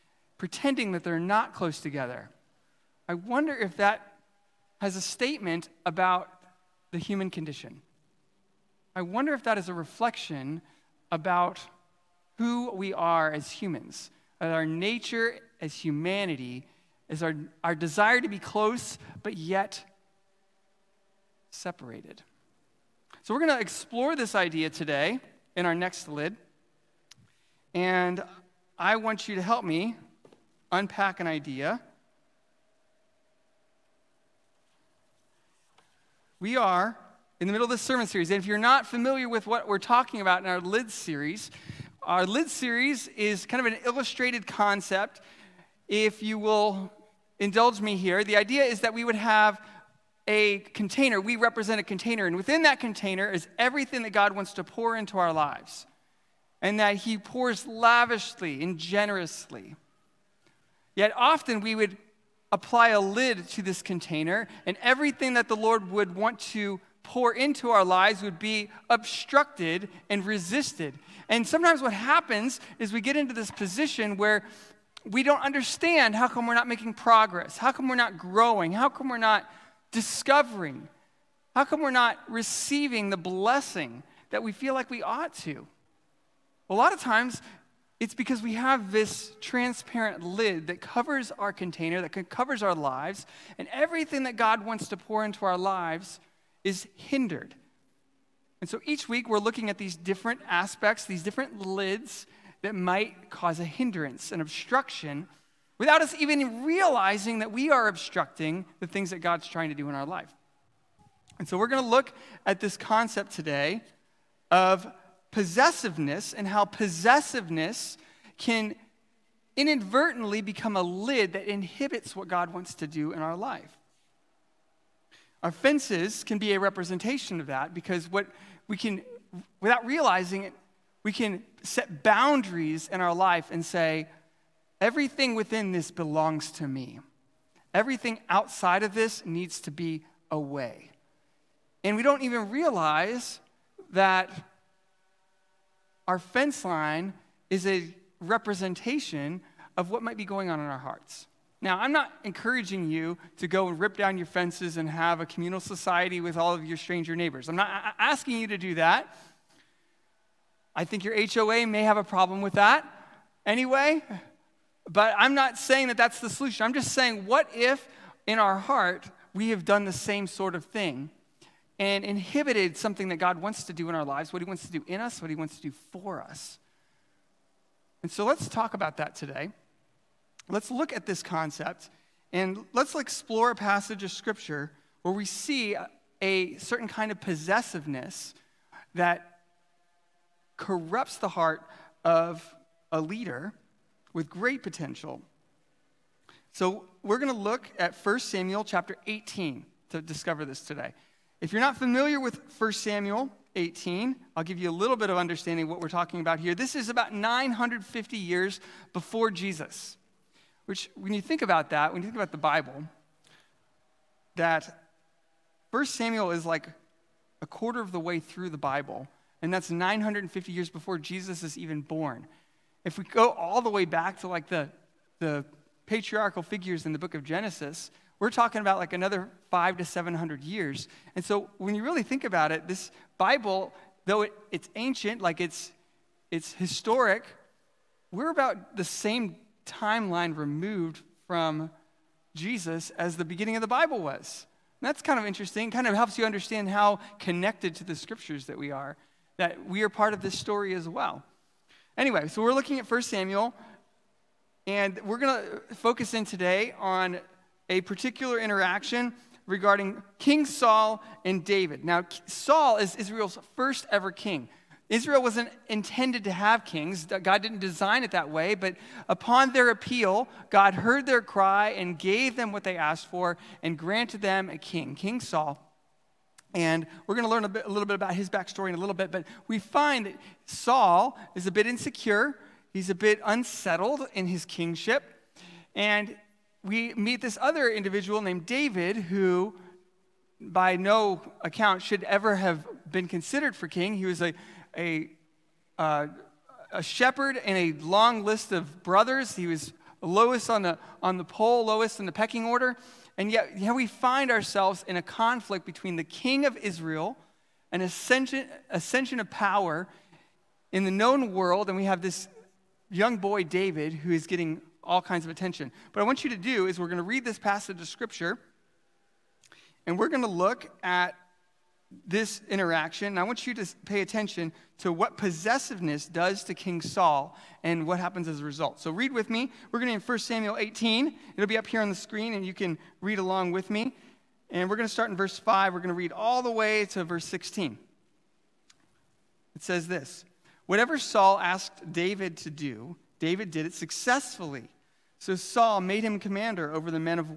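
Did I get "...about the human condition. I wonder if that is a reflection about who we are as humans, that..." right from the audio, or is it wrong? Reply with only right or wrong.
right.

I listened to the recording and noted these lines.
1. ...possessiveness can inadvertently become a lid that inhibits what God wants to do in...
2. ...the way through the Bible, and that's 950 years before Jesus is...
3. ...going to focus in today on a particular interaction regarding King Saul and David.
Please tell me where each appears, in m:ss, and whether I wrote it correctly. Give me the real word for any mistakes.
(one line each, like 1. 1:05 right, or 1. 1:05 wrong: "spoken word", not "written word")
1. 1:56 right
2. 3:37 right
3. 4:15 right.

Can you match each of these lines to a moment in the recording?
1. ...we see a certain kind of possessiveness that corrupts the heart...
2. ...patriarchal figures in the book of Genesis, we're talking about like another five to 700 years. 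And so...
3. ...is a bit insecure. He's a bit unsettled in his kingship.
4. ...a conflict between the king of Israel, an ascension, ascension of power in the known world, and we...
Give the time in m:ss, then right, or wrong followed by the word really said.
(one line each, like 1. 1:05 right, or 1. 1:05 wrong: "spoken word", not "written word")
1. 3:05 right
2. 3:45 right
3. 4:41 right
4. 5:04 right.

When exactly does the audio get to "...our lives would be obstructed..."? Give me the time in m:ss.
1:07.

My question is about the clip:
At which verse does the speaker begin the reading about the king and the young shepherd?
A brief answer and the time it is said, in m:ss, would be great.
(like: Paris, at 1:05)
Verse 5, at 5:35.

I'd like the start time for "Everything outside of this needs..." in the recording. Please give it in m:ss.
2:17.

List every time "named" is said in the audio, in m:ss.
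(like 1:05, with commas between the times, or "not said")
4:48.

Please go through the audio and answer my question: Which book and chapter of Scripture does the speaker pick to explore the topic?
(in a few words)
1 Samuel 18.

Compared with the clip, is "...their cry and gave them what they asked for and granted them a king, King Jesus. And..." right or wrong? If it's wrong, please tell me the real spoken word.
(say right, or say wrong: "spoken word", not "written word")
wrong: "Saul", not "Jesus".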